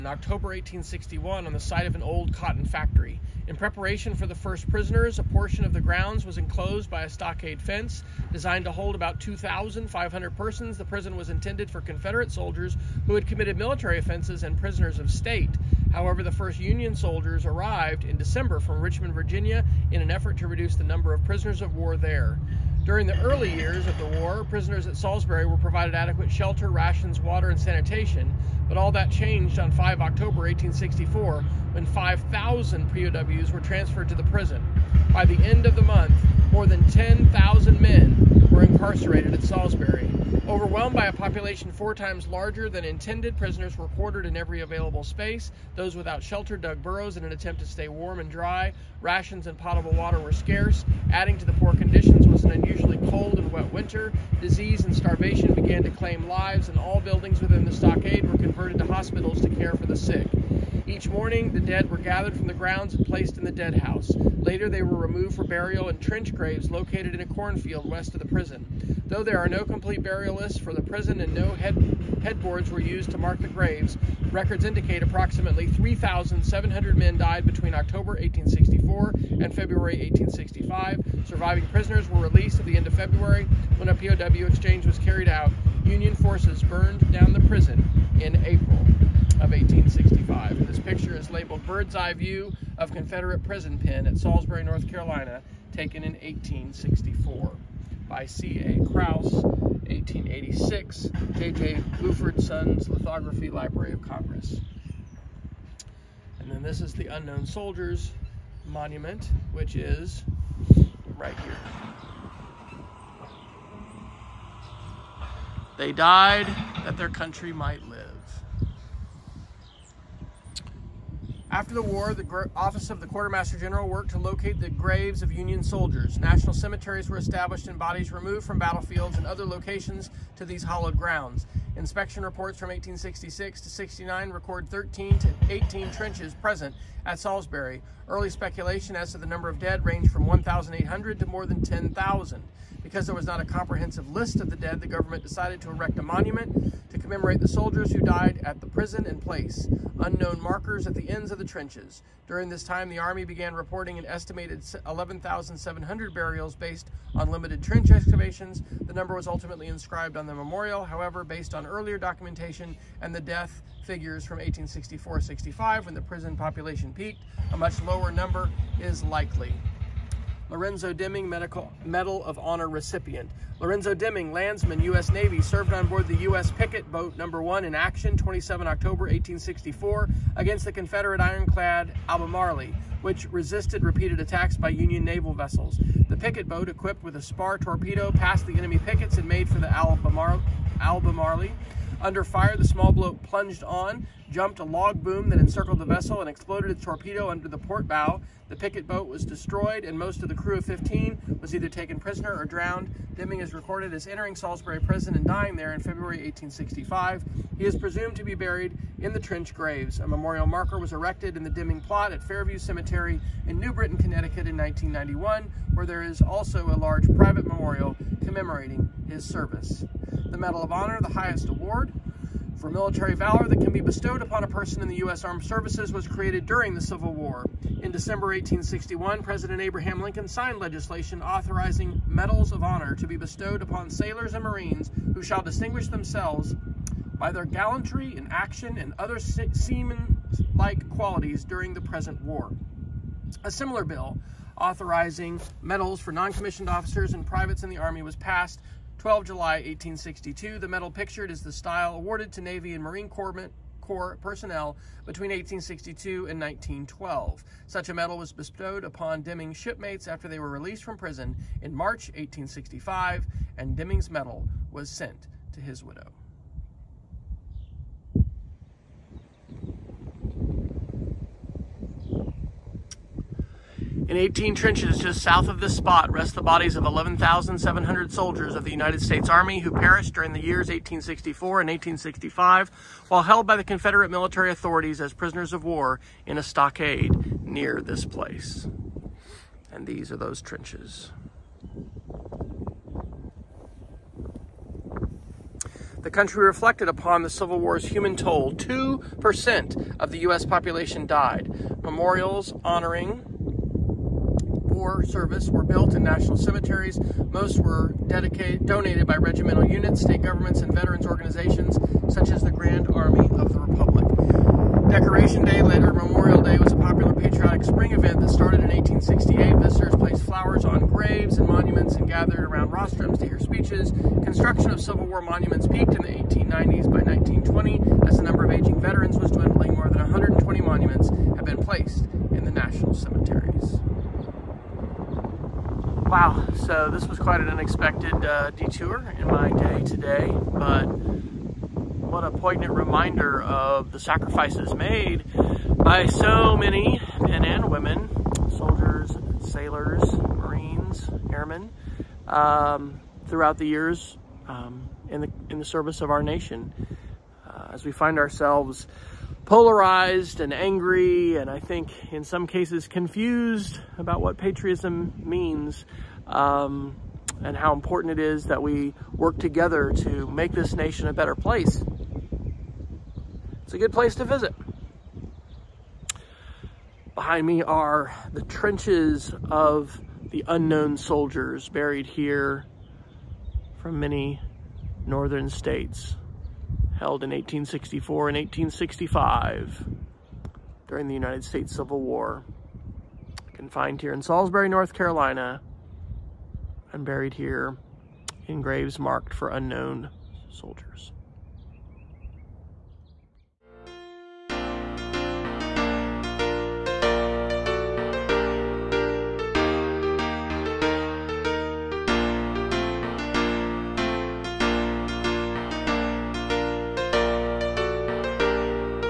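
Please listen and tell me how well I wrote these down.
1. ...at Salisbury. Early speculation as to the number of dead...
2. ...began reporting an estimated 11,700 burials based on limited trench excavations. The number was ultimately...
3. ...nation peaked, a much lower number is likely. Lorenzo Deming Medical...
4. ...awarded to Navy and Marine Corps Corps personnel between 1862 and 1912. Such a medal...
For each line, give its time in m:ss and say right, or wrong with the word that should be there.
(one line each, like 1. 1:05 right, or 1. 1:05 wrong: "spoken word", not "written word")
1. 2:17 right
2. 2:33 right
3. 2:46 wrong: "population", not "nation"
4. 4:11 right.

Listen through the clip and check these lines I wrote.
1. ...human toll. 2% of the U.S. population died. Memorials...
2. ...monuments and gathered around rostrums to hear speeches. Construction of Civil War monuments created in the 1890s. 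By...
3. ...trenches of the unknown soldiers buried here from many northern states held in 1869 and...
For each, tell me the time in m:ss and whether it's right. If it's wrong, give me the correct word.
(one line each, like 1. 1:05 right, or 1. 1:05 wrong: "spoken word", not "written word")
1. 4:57 right
2. 5:21 wrong: "peaked", not "created"
3. 6:18 wrong: "1864", not "1869".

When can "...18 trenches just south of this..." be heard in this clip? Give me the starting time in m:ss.
4:34.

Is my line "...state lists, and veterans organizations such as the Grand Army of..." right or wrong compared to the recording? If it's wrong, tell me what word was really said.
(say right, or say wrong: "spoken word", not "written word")
wrong: "governments", not "lists".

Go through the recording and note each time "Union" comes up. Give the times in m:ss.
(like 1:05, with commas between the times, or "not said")
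0:16, 1:25, 2:05, 3:04.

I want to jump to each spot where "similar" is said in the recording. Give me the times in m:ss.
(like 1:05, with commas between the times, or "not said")
4:03.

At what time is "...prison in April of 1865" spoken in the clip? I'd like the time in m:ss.
1:27.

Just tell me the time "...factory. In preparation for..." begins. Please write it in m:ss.
0:02.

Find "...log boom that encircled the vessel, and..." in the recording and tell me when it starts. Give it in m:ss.
3:14.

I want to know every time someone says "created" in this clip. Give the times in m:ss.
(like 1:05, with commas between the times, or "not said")
3:46.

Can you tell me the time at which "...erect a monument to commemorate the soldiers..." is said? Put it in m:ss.
2:25.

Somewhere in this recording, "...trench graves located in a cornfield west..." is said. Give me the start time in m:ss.
1:05.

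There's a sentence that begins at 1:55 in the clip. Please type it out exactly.
They died that their country might live.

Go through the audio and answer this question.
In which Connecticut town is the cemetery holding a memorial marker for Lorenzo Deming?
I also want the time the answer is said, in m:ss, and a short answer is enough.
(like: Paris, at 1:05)
New Britain, at 3:33.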